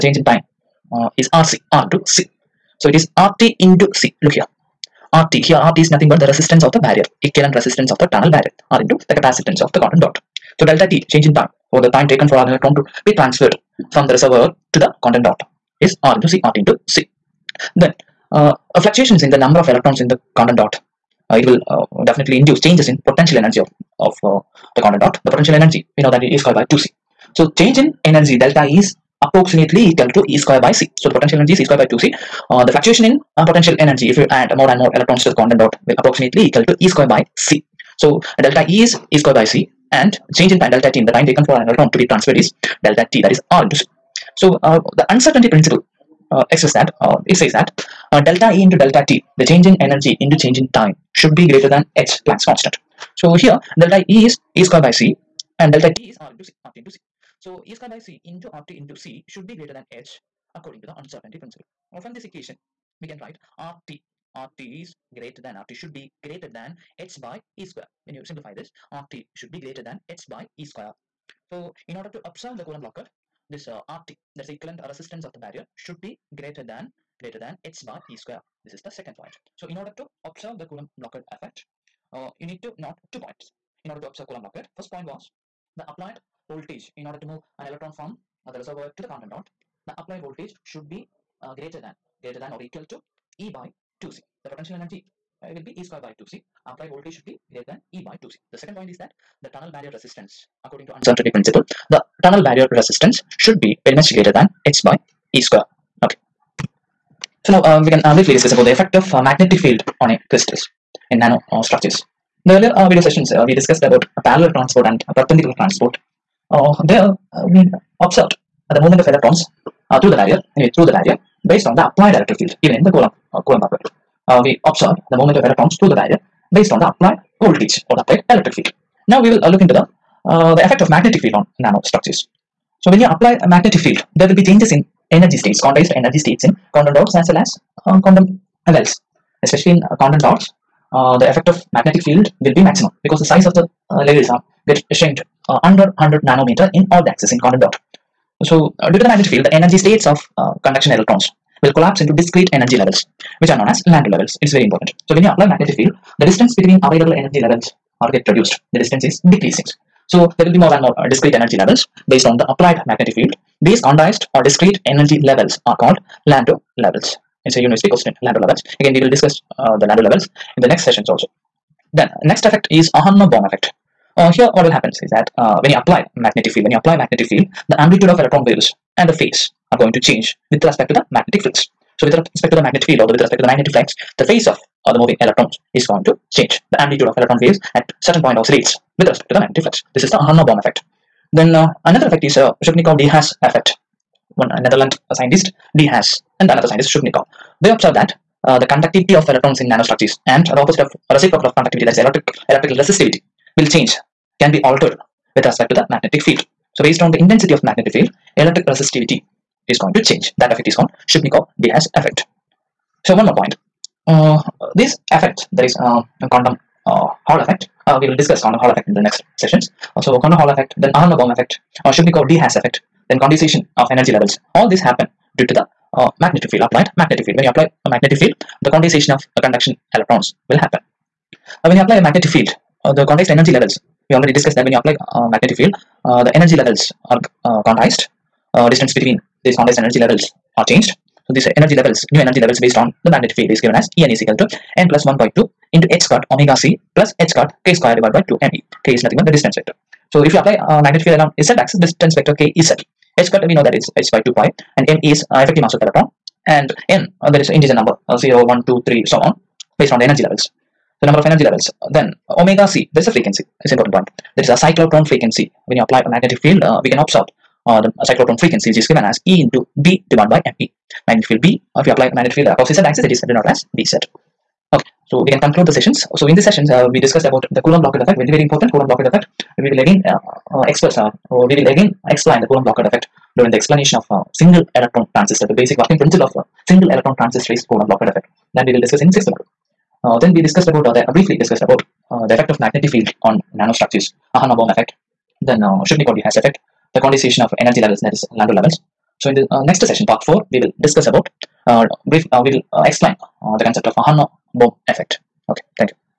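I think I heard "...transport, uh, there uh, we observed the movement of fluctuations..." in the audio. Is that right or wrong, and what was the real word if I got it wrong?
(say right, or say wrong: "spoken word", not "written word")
wrong: "electrons", not "fluctuations".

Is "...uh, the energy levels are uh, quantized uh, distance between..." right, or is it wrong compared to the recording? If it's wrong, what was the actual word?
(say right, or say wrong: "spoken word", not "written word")
right.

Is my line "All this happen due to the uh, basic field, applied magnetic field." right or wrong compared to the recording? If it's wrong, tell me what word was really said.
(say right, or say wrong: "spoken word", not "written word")
wrong: "magnetic", not "basic".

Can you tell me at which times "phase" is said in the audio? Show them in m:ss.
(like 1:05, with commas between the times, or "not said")
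2:59, 3:04.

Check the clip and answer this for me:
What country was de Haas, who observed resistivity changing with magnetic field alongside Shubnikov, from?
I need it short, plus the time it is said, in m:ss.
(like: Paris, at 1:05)
Netherlands, at 3:14.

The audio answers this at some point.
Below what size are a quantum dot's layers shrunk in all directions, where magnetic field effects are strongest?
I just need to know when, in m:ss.
2:26.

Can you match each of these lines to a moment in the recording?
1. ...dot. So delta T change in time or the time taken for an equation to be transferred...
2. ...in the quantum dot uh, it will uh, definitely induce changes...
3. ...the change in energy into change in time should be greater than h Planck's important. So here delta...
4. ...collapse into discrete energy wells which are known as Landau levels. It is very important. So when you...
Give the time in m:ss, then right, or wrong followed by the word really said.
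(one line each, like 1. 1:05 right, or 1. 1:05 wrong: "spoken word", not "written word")
1. 0:10 wrong: "electron", not "equation"
2. 0:20 right
3. 0:49 wrong: "constant", not "important"
4. 2:31 wrong: "levels", not "wells".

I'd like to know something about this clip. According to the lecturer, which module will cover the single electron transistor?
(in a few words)
Sixth module.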